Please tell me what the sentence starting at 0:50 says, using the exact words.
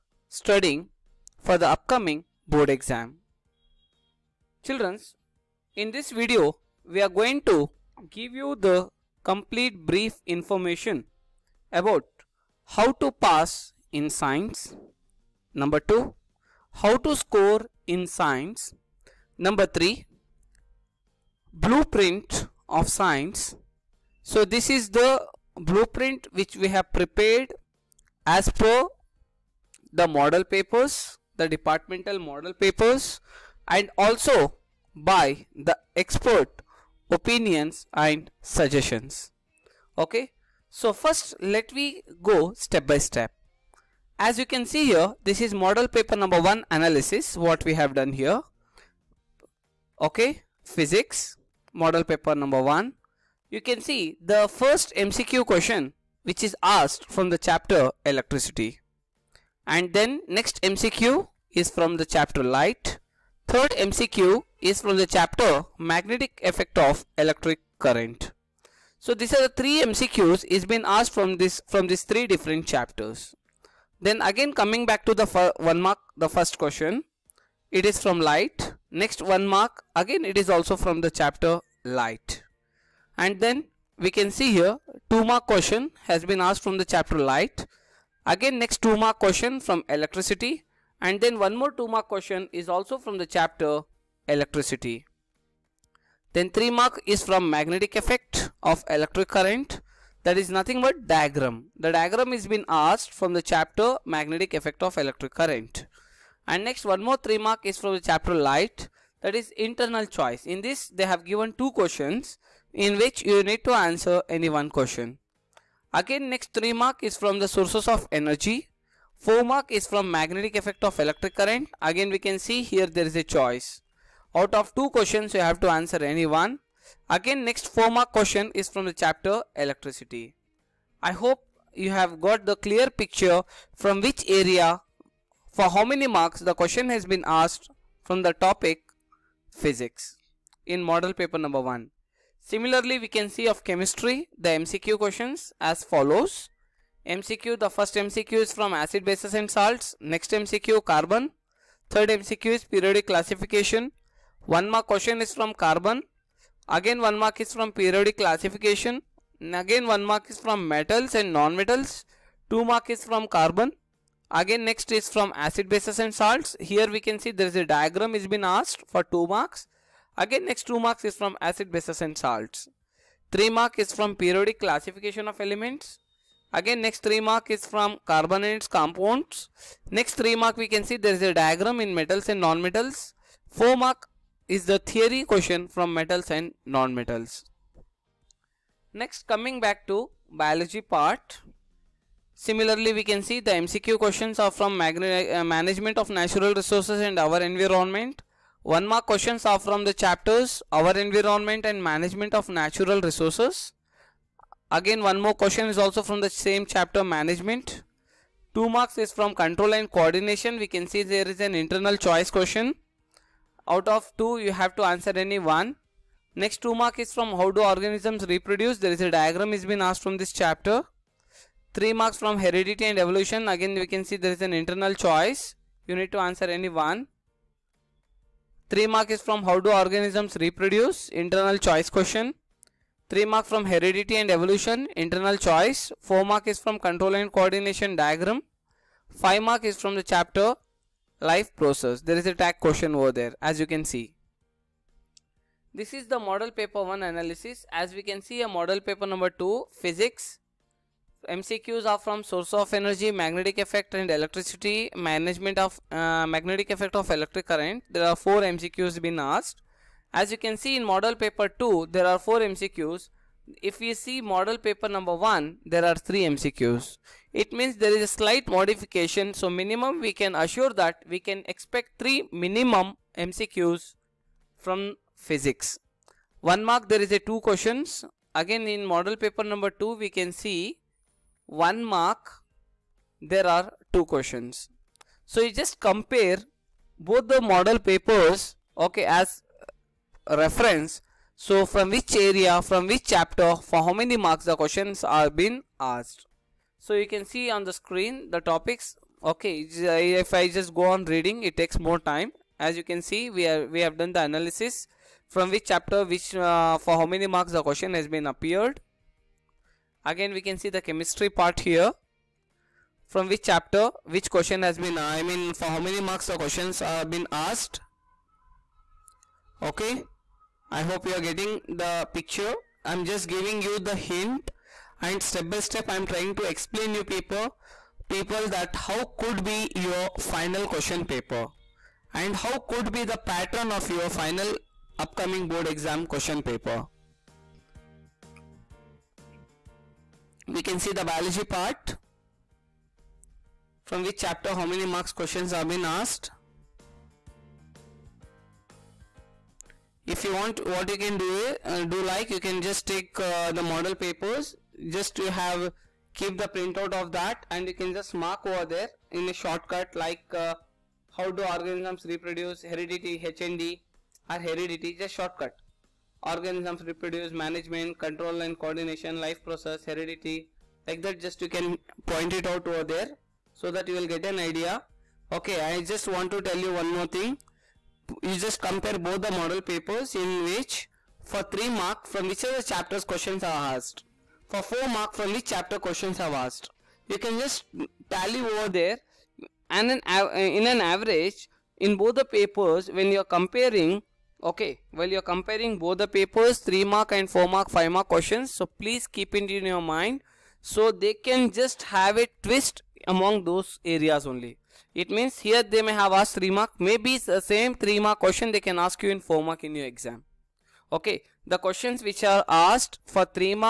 Okay, physics model paper number 1.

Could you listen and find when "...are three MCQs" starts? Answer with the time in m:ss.
4:25.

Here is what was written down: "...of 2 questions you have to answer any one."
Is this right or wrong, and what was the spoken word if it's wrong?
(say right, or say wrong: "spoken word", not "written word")
right.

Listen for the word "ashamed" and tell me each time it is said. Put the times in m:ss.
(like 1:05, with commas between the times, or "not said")
not said.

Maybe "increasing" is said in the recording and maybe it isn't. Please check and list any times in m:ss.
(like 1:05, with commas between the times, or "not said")
not said.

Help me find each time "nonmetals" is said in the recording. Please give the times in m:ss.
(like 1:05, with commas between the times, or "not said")
3:02, 3:06.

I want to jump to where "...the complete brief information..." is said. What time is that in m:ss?
0:08.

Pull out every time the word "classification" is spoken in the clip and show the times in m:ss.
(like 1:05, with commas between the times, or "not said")
2:33, 2:38, 2:54.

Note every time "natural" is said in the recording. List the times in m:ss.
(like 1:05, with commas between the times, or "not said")
3:16, 3:22.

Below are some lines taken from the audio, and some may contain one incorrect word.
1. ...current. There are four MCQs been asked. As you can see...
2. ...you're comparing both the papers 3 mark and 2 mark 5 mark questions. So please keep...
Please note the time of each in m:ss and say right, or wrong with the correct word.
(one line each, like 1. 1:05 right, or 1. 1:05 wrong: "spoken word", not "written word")
1. 4:17 right
2. 6:35 wrong: "4", not "2".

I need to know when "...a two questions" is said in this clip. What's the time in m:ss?
4:37.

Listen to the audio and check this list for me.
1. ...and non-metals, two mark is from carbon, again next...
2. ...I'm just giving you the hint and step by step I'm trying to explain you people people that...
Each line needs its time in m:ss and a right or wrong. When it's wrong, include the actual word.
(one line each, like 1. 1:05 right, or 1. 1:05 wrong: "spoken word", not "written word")
1. 2:41 right
2. 5:22 right.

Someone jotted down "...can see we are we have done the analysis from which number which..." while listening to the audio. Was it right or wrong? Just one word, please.
wrong.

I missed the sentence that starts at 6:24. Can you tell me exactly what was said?
For 4 mark from which chapter questions are asked.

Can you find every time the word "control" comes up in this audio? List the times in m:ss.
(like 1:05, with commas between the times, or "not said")
3:29, 3:56, 6:07.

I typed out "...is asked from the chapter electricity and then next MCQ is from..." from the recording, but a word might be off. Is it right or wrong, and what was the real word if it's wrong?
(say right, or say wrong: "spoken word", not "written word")
right.